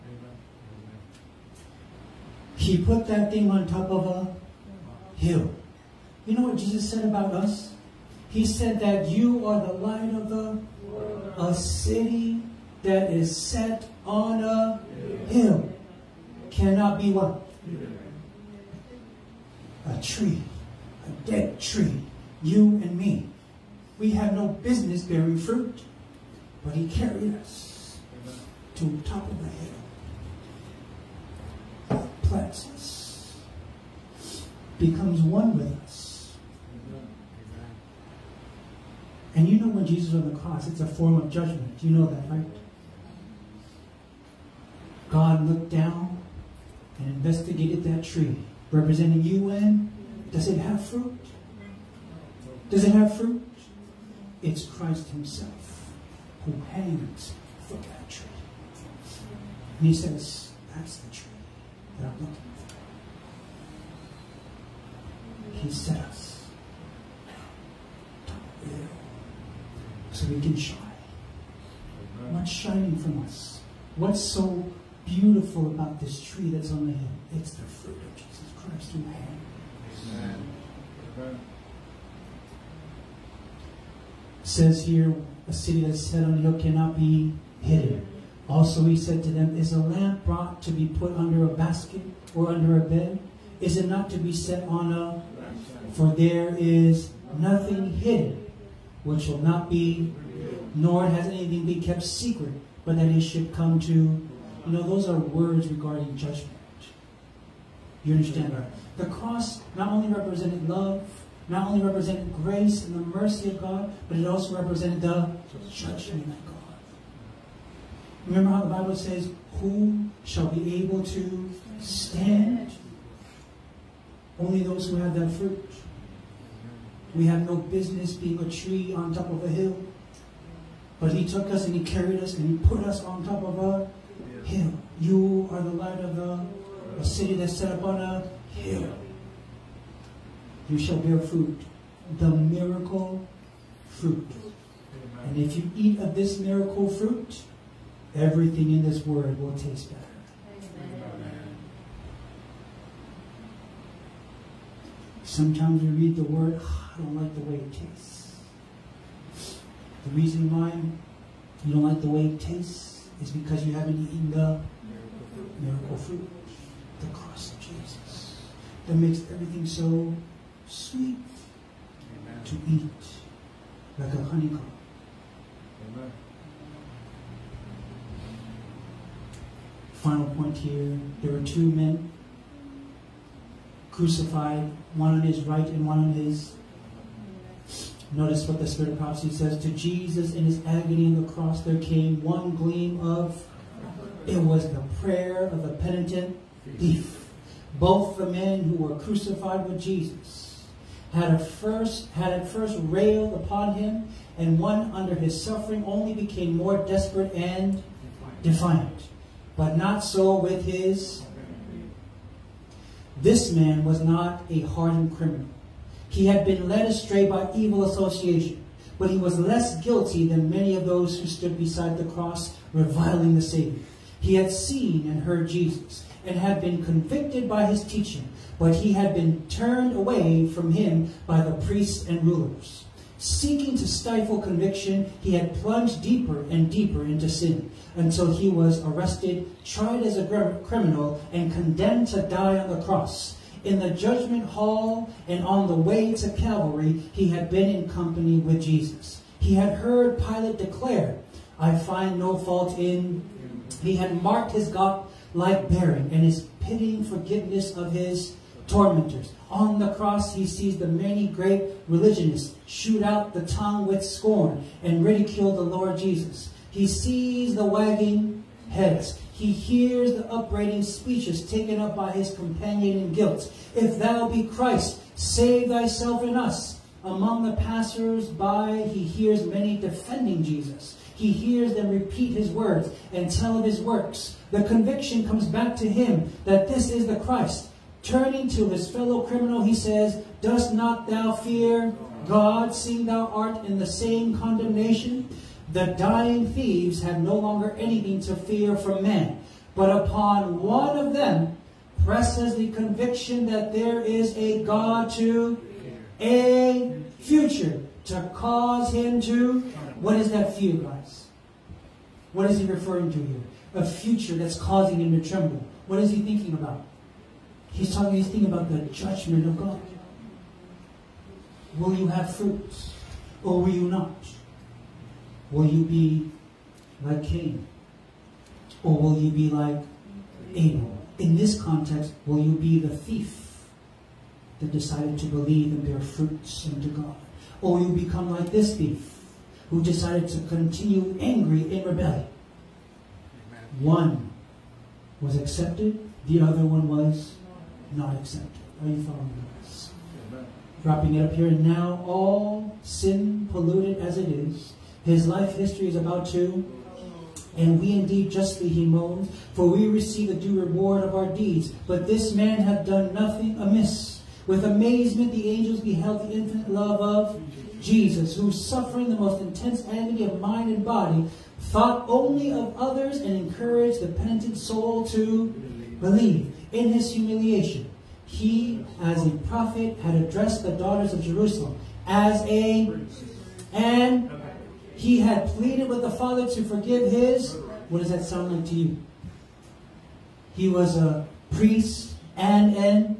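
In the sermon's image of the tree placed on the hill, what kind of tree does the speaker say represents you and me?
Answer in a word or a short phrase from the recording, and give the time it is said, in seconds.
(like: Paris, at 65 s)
A dead tree, at 21 s.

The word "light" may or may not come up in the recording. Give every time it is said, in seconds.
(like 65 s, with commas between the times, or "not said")
9 s, 135 s.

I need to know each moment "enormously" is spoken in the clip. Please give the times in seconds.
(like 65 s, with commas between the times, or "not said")
not said.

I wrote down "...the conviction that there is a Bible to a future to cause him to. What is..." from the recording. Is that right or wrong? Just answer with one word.
wrong.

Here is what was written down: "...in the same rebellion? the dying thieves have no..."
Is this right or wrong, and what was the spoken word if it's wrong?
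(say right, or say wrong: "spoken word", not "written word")
wrong: "condemnation", not "rebellion".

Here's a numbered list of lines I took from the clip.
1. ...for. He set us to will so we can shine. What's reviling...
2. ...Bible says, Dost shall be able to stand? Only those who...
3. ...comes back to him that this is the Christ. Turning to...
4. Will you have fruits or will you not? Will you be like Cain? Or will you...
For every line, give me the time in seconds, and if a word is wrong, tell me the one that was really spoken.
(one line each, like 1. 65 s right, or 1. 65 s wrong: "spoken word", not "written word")
1. 65 s wrong: "shining", not "reviling"
2. 118 s wrong: "Who", not "Dost"
3. 285 s right
4. 321 s right.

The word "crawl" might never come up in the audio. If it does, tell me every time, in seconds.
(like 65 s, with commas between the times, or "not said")
not said.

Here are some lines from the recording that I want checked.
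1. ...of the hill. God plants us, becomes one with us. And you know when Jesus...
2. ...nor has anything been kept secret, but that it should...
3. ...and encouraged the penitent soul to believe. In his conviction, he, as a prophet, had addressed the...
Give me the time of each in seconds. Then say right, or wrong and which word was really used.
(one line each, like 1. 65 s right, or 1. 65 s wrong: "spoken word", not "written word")
1. 29 s right
2. 100 s right
3. 373 s wrong: "humiliation", not "conviction".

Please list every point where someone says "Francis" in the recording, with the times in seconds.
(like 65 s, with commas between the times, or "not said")
not said.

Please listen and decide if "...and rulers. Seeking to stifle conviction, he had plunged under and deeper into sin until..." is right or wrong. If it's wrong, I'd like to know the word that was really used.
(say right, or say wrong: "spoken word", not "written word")
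wrong: "deeper", not "under".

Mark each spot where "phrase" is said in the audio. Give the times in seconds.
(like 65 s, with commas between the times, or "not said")
not said.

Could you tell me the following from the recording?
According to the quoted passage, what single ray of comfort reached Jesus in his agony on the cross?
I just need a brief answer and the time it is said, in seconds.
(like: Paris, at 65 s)
Prayer of a penitent thief, at 195 s.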